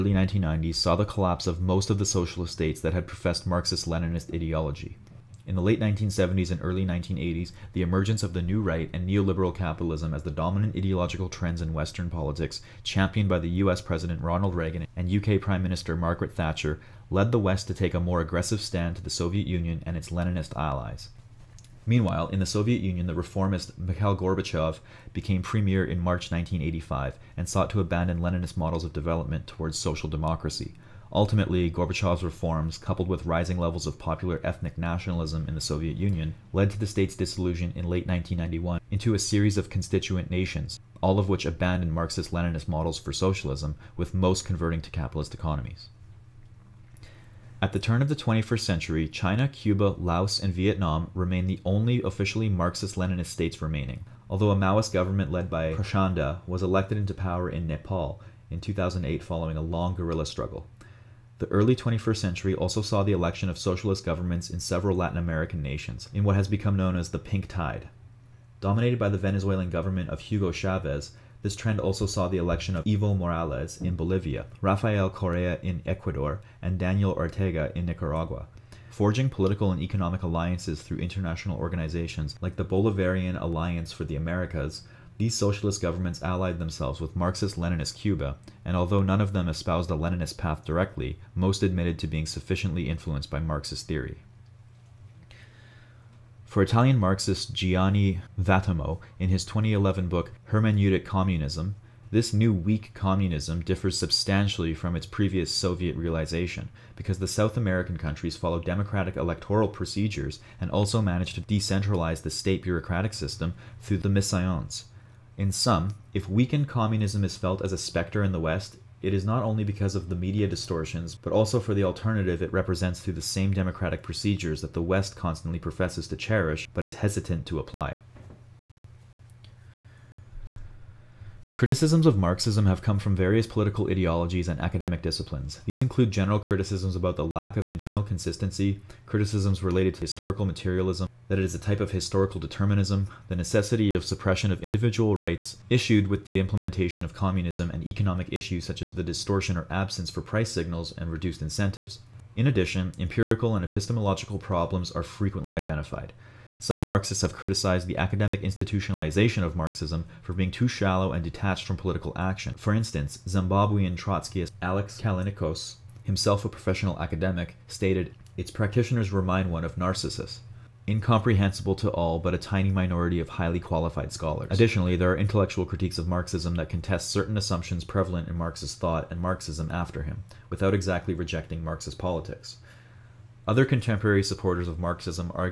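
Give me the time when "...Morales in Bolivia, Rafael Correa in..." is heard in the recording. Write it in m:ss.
1:13.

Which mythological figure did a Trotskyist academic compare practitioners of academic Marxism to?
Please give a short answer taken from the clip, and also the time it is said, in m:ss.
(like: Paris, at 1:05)
Narcissus, at 2:49.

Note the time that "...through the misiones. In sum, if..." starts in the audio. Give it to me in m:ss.
1:53.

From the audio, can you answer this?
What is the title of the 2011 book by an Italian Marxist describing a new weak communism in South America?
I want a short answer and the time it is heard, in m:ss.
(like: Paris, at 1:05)
Hermeneutic Communism, at 1:40.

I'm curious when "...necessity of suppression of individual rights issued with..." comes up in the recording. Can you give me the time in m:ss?
2:23.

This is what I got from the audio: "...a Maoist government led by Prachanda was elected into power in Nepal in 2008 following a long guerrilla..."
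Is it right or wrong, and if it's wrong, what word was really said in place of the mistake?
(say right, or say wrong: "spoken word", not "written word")
right.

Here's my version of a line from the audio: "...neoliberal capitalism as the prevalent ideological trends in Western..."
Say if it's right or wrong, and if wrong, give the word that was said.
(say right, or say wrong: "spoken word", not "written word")
wrong: "dominant", not "prevalent".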